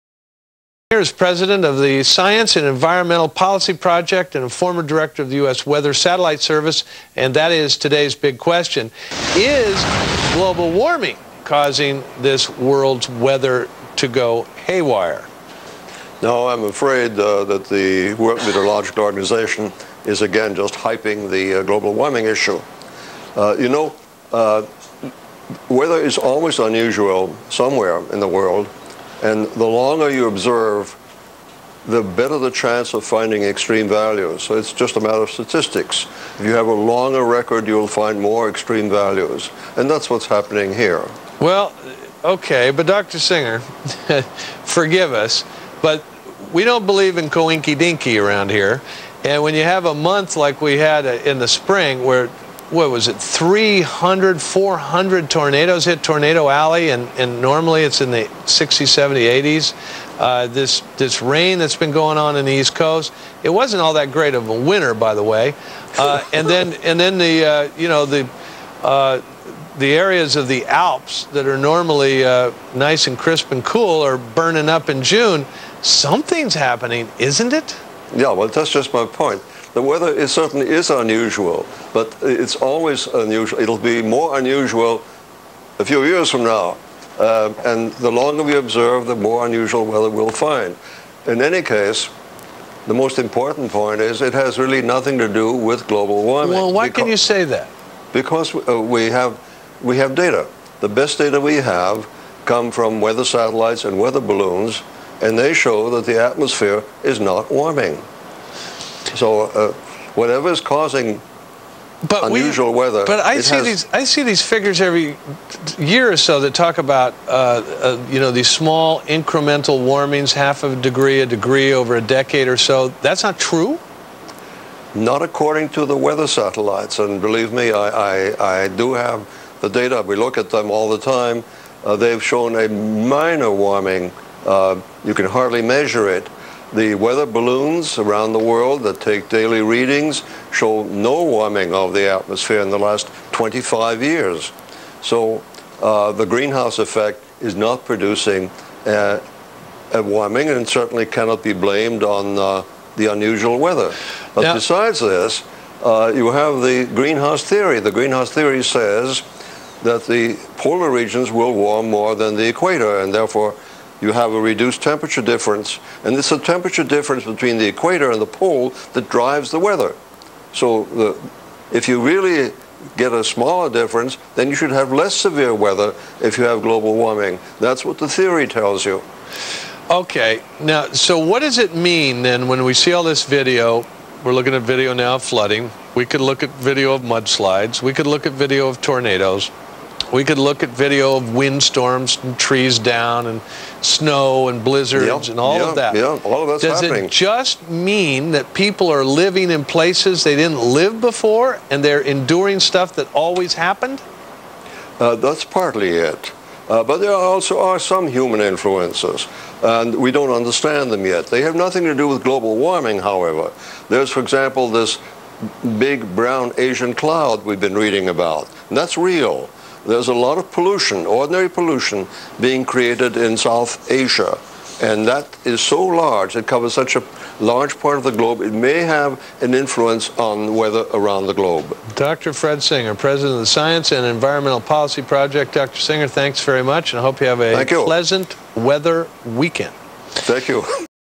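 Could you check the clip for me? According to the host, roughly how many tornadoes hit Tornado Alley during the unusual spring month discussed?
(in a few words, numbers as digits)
300, 400.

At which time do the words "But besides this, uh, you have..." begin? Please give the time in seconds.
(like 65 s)
154 s.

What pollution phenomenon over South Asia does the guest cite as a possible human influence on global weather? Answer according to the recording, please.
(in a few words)
big brown Asian cloud.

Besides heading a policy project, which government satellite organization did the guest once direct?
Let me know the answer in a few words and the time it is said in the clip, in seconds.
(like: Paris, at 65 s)
U.S. Weather Satellite Service, at 5 s.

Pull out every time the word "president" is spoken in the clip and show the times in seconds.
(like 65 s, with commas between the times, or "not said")
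1 s, 232 s.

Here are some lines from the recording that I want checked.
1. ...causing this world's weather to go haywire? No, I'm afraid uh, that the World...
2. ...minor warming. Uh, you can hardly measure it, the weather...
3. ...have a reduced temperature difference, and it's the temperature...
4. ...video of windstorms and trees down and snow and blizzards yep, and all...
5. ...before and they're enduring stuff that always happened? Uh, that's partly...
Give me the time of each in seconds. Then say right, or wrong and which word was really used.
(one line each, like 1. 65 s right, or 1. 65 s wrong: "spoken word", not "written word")
1. 11 s right
2. 132 s right
3. 164 s right
4. 190 s right
5. 200 s right.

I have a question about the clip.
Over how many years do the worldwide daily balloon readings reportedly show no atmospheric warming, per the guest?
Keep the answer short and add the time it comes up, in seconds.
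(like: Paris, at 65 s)
25, at 143 s.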